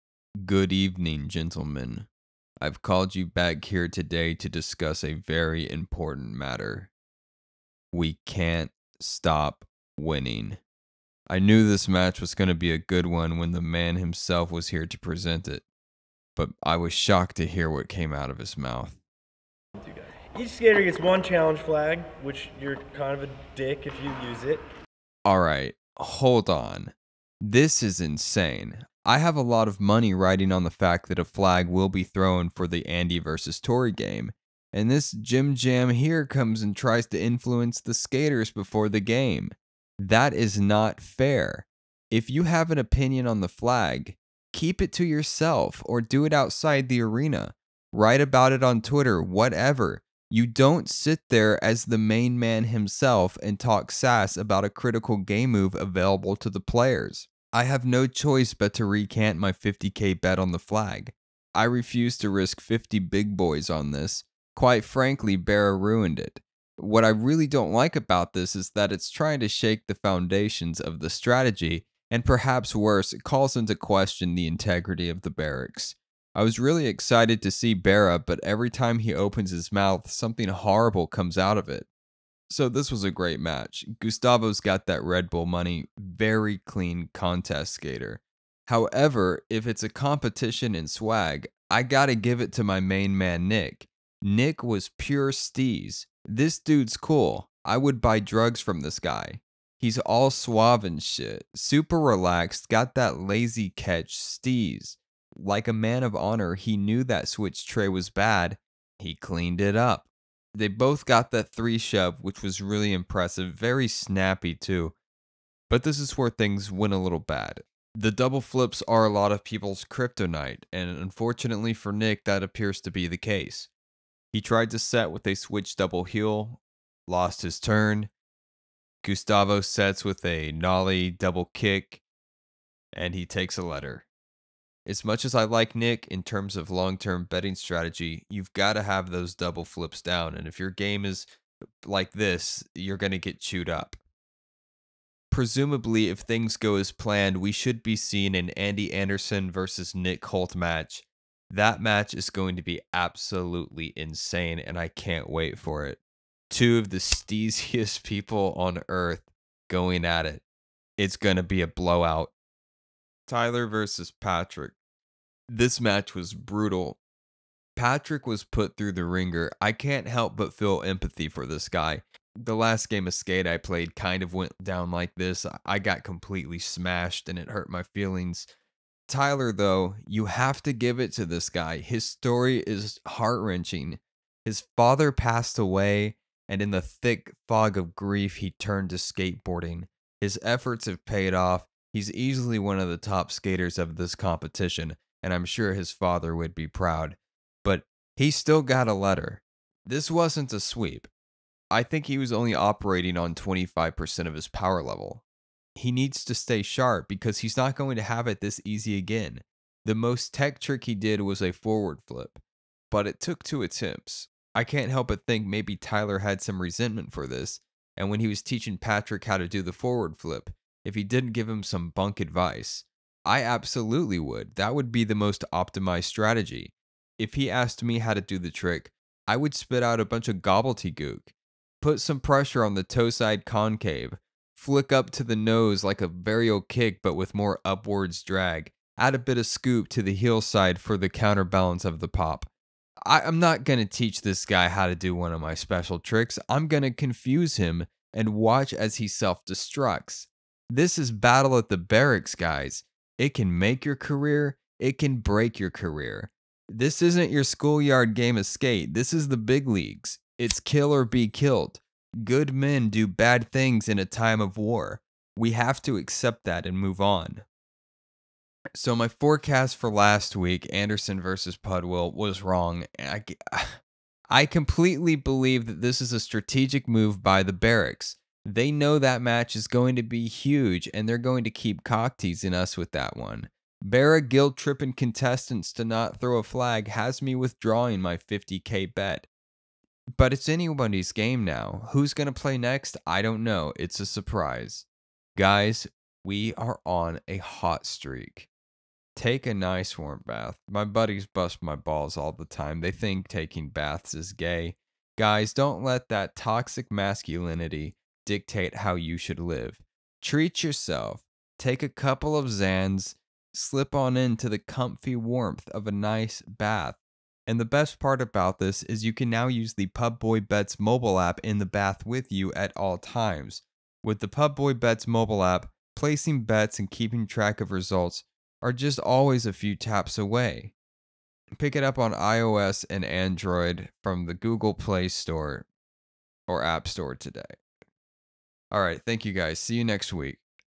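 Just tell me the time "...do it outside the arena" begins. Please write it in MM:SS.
00:46.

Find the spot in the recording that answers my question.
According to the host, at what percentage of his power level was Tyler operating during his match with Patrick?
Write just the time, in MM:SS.
03:23.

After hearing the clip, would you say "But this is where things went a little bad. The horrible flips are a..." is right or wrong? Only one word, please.
wrong.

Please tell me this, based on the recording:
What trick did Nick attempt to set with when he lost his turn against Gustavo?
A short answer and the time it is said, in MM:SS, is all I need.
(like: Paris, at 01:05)
switch double heel, at 02:05.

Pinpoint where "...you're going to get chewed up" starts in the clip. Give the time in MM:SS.
02:22.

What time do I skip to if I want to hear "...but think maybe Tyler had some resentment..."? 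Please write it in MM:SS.
03:35.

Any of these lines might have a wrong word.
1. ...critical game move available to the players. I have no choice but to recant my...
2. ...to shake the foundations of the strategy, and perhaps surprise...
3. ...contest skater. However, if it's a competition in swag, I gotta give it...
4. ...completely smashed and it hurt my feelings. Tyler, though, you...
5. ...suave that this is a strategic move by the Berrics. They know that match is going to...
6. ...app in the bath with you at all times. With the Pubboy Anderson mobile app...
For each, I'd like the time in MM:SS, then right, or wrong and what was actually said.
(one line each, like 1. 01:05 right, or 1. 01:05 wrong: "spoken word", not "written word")
1. 00:54 right
2. 01:09 wrong: "worse", not "surprise"
3. 01:27 right
4. 02:56 right
5. 04:35 wrong: "believe", not "suave"
6. 05:21 wrong: "Bets", not "Anderson".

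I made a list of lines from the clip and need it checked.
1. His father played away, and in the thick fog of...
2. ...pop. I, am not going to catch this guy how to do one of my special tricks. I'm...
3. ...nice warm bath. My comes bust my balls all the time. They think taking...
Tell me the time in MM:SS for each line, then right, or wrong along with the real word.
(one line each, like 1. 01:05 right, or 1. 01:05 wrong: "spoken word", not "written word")
1. 03:04 wrong: "passed", not "played"
2. 04:02 wrong: "teach", not "catch"
3. 04:59 wrong: "buddies", not "comes".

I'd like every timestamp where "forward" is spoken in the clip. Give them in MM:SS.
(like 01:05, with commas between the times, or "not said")
03:31, 03:39.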